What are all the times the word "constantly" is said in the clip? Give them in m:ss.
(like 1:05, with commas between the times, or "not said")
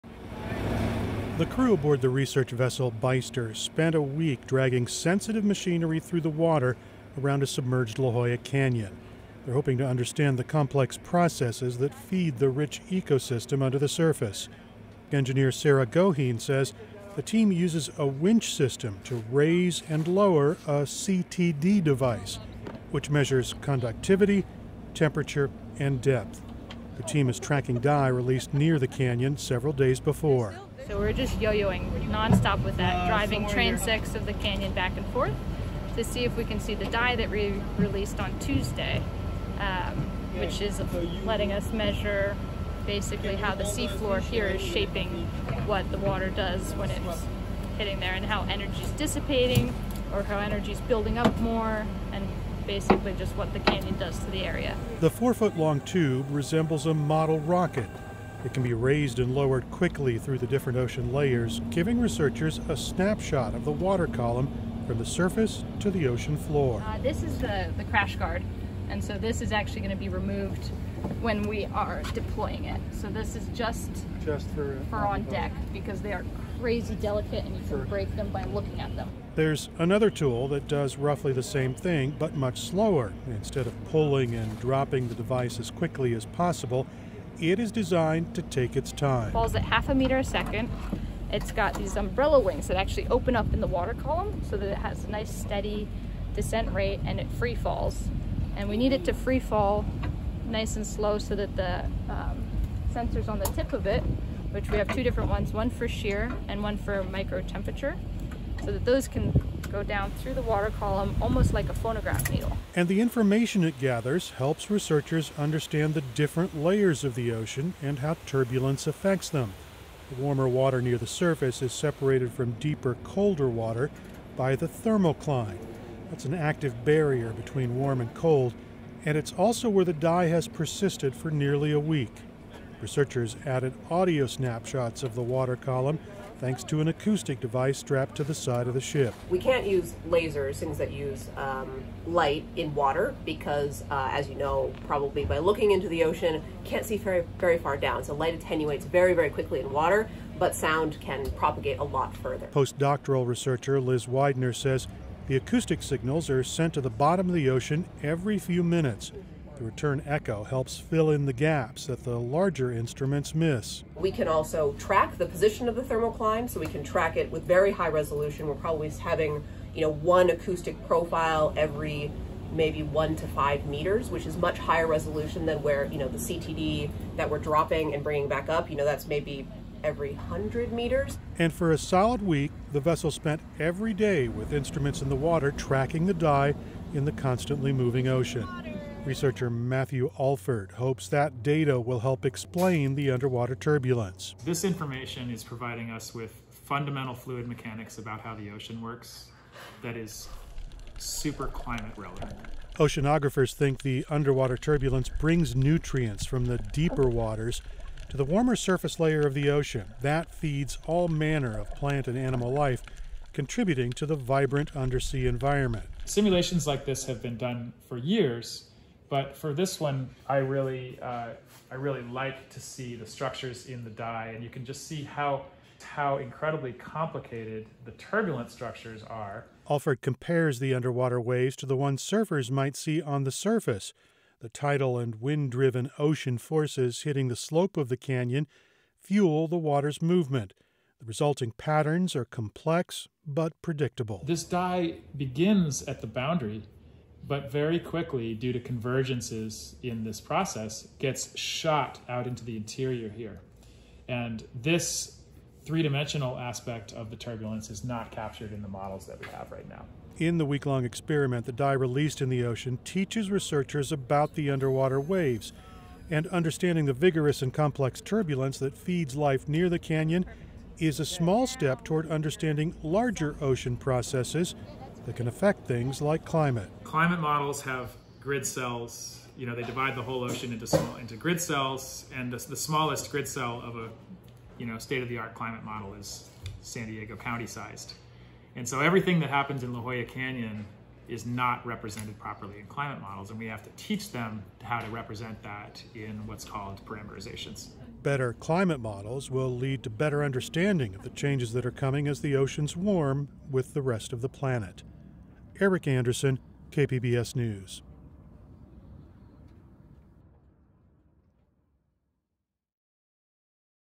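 3:07.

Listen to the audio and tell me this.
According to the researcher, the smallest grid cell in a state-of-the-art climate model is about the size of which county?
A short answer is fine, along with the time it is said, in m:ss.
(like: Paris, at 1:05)
San Diego County, at 4:46.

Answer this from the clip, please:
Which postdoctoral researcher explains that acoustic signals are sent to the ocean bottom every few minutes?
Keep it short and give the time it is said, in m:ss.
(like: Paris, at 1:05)
Liz Widener, at 2:33.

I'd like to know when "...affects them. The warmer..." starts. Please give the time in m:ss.
1:58.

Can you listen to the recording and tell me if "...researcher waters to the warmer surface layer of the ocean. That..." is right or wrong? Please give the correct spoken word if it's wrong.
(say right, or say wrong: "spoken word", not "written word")
wrong: "deeper", not "researcher".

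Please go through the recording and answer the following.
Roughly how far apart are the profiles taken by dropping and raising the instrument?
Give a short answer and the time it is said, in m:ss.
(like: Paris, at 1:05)
100 meters, at 2:59.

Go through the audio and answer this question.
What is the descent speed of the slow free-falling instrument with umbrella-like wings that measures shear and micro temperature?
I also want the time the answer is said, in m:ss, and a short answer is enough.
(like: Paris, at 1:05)
half a meter a second, at 1:29.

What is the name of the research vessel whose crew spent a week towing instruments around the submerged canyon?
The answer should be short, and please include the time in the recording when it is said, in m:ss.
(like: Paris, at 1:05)
Beyster, at 0:02.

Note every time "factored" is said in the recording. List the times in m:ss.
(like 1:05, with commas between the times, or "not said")
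not said.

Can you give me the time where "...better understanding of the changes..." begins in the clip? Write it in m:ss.
4:59.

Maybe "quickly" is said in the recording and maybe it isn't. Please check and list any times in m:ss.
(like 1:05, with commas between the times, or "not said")
0:59, 1:25, 2:29, 4:07.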